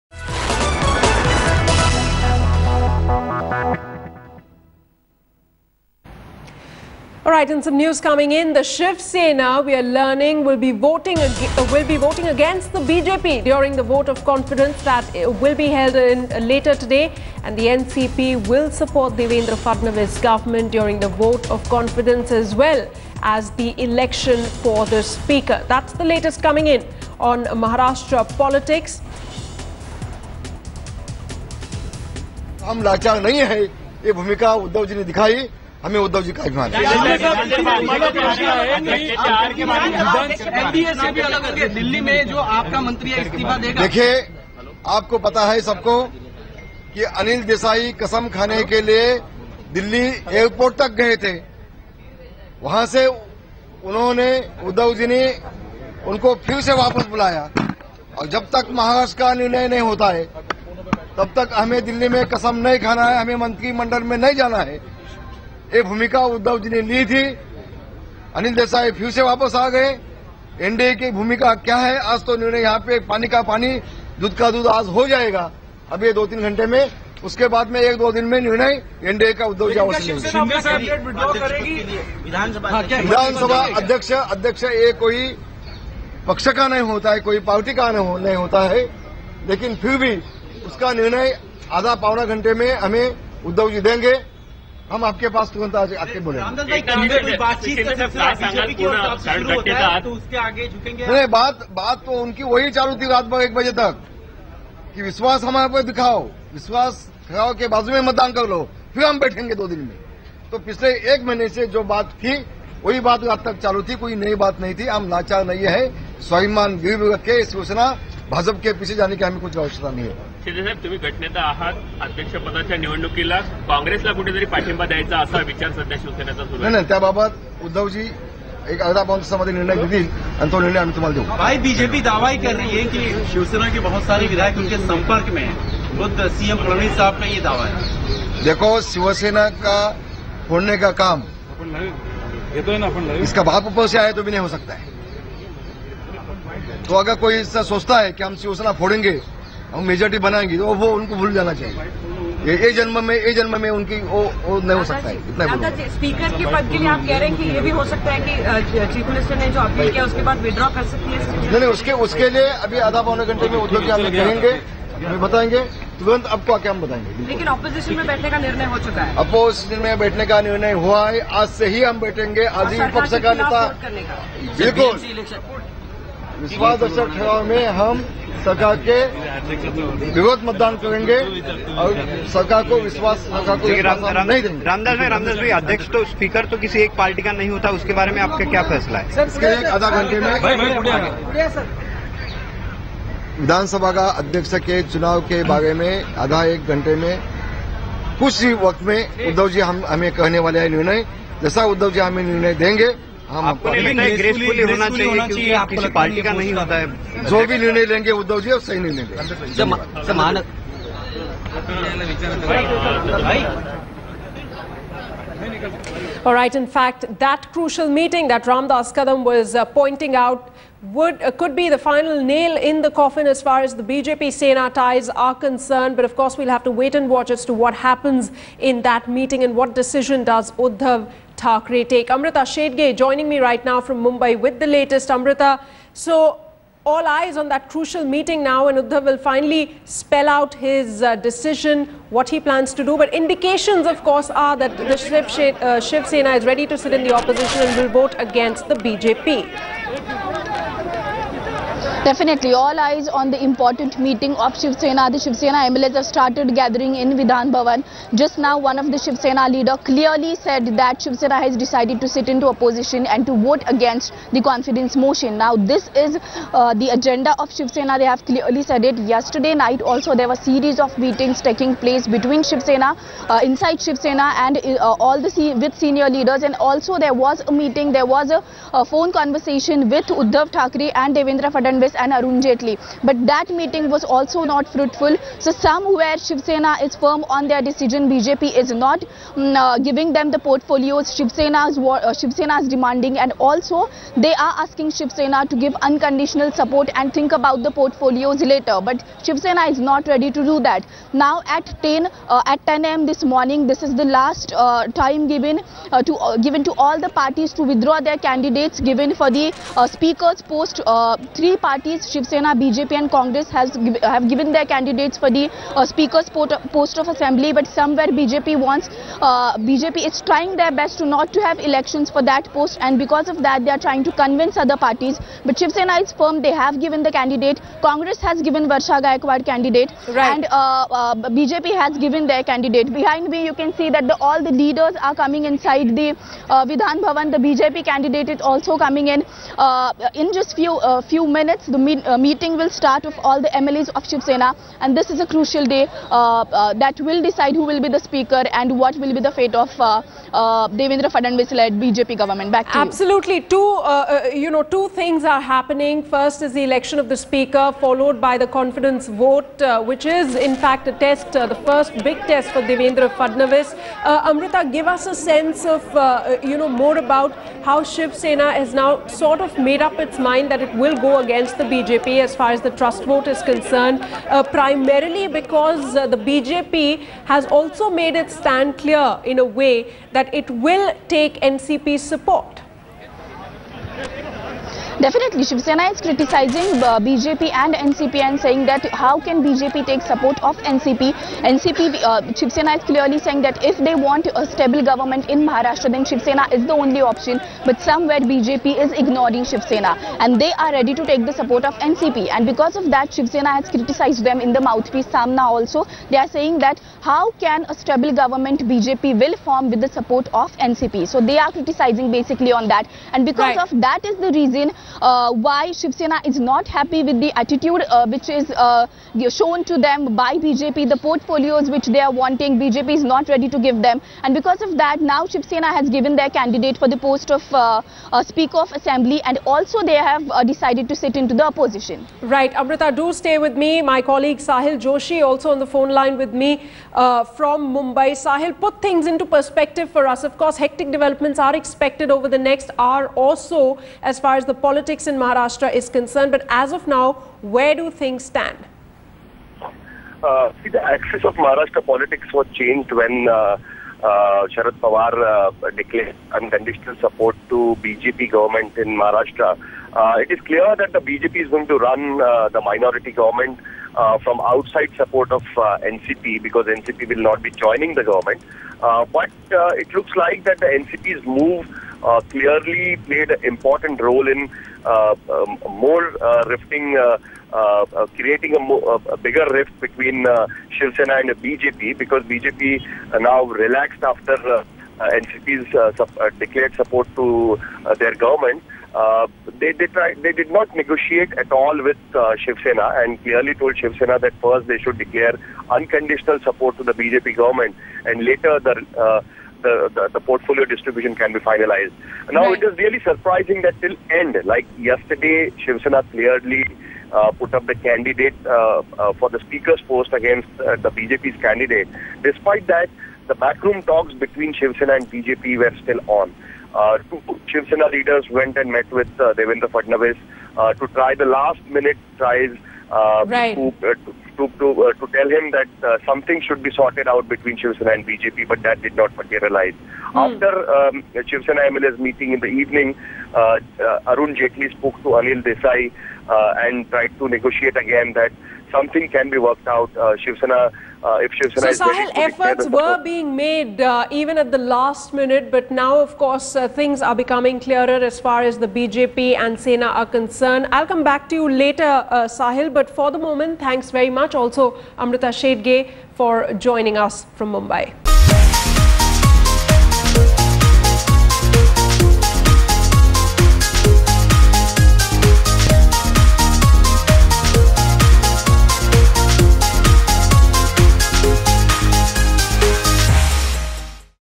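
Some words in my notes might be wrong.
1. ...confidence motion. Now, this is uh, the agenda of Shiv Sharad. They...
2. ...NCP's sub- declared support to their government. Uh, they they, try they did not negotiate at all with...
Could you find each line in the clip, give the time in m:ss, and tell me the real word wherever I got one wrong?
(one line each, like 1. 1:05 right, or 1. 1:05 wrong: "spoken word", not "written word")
1. 4:24 wrong: "Sena", not "Sharad"
2. 8:04 right.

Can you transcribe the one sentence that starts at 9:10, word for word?
I'll come back to you later, uh, Sahil, but for the moment, thanks very much.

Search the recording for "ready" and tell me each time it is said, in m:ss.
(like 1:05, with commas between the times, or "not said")
4:06, 5:00, 6:40, 7:03.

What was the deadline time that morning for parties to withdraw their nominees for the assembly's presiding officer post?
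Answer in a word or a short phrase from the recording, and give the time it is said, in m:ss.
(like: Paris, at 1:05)
10 a.m., at 5:02.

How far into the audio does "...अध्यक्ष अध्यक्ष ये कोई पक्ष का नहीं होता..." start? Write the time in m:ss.
1:23.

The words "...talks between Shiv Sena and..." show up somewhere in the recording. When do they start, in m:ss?
8:33.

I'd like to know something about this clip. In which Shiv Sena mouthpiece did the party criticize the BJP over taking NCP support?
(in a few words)
Samna.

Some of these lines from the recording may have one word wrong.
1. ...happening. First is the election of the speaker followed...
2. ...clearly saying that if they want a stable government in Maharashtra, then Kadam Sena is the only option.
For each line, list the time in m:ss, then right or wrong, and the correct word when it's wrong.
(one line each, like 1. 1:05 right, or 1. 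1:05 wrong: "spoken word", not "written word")
1. 5:55 right
2. 6:32 wrong: "Shiv", not "Kadam".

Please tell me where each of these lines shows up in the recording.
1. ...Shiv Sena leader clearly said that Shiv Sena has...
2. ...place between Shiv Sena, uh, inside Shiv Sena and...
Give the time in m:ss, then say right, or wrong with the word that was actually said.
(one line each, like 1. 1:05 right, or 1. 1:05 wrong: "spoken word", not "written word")
1. 4:18 right
2. 4:31 right.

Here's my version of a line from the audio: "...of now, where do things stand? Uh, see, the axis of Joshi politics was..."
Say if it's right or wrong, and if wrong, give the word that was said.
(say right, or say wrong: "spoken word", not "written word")
wrong: "Maharashtra", not "Joshi".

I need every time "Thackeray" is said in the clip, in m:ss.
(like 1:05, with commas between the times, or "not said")
3:51, 4:40.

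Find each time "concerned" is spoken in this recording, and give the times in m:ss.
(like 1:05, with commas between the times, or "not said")
3:45, 6:13, 7:25, 9:10.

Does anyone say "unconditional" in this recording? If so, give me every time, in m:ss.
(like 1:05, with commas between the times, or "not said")
4:55, 7:36, 8:15.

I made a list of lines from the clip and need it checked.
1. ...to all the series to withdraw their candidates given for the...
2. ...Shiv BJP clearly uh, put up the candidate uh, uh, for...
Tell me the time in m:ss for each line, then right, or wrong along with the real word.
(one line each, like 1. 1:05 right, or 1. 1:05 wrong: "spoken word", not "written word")
1. 5:06 wrong: "parties", not "series"
2. 8:25 wrong: "Sena", not "BJP".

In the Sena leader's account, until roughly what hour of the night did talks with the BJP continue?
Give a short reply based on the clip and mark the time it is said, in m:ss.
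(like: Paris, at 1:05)
1 o'clock, at 1:43.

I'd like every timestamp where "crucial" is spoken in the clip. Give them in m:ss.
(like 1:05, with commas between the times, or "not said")
3:37, 3:57, 5:45.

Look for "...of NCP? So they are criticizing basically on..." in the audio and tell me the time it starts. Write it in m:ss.
6:50.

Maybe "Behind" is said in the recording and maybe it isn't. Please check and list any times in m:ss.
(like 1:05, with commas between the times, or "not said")
5:32.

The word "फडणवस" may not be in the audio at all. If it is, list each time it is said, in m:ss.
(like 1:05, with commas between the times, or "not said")
2:16.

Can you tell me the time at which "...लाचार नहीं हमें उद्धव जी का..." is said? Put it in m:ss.
0:32.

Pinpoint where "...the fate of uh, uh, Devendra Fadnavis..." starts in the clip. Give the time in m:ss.
5:49.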